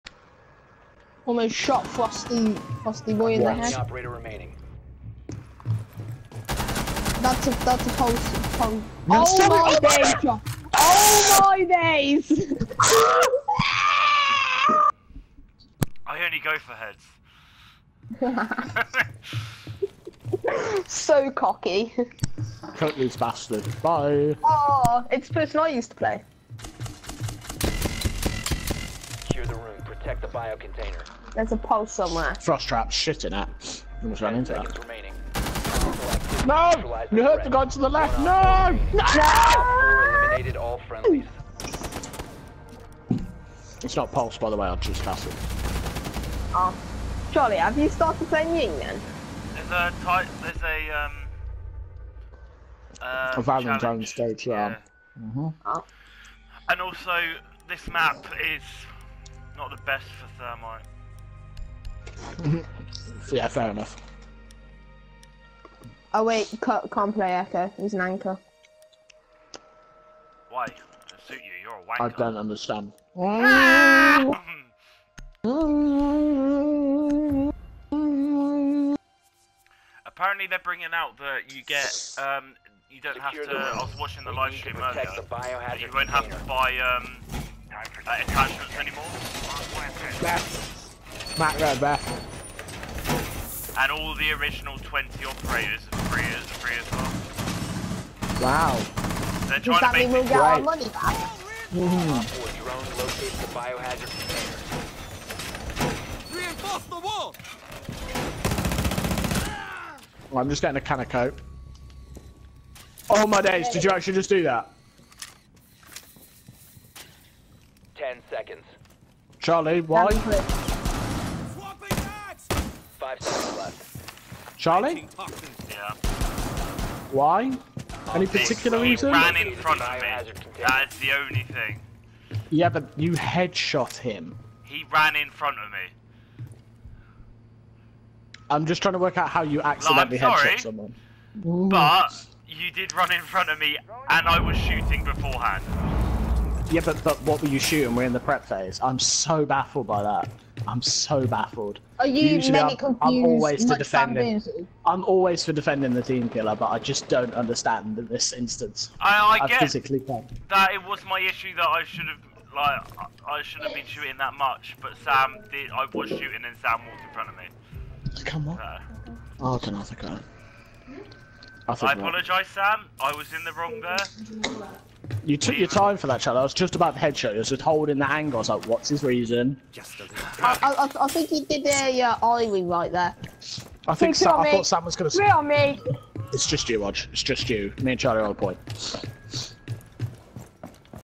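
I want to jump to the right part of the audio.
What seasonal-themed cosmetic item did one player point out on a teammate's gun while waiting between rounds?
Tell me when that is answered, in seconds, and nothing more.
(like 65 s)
53 s.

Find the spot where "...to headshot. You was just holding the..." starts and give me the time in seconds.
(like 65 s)
176 s.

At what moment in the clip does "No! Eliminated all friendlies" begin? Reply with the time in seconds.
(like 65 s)
38 s.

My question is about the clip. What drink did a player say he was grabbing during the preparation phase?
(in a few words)
Coke.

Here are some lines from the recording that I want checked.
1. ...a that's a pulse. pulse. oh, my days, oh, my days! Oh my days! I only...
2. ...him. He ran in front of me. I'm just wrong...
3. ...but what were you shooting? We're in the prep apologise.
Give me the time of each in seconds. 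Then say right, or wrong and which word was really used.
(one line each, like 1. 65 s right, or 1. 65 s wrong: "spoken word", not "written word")
1. 7 s right
2. 133 s wrong: "trying", not "wrong"
3. 147 s wrong: "phase", not "apologise".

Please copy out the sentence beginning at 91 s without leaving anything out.
Matt right And all the original 20 operators are free, free as well.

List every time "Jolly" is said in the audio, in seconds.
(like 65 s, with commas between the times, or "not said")
47 s.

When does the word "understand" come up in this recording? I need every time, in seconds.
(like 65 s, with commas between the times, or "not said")
72 s, 157 s.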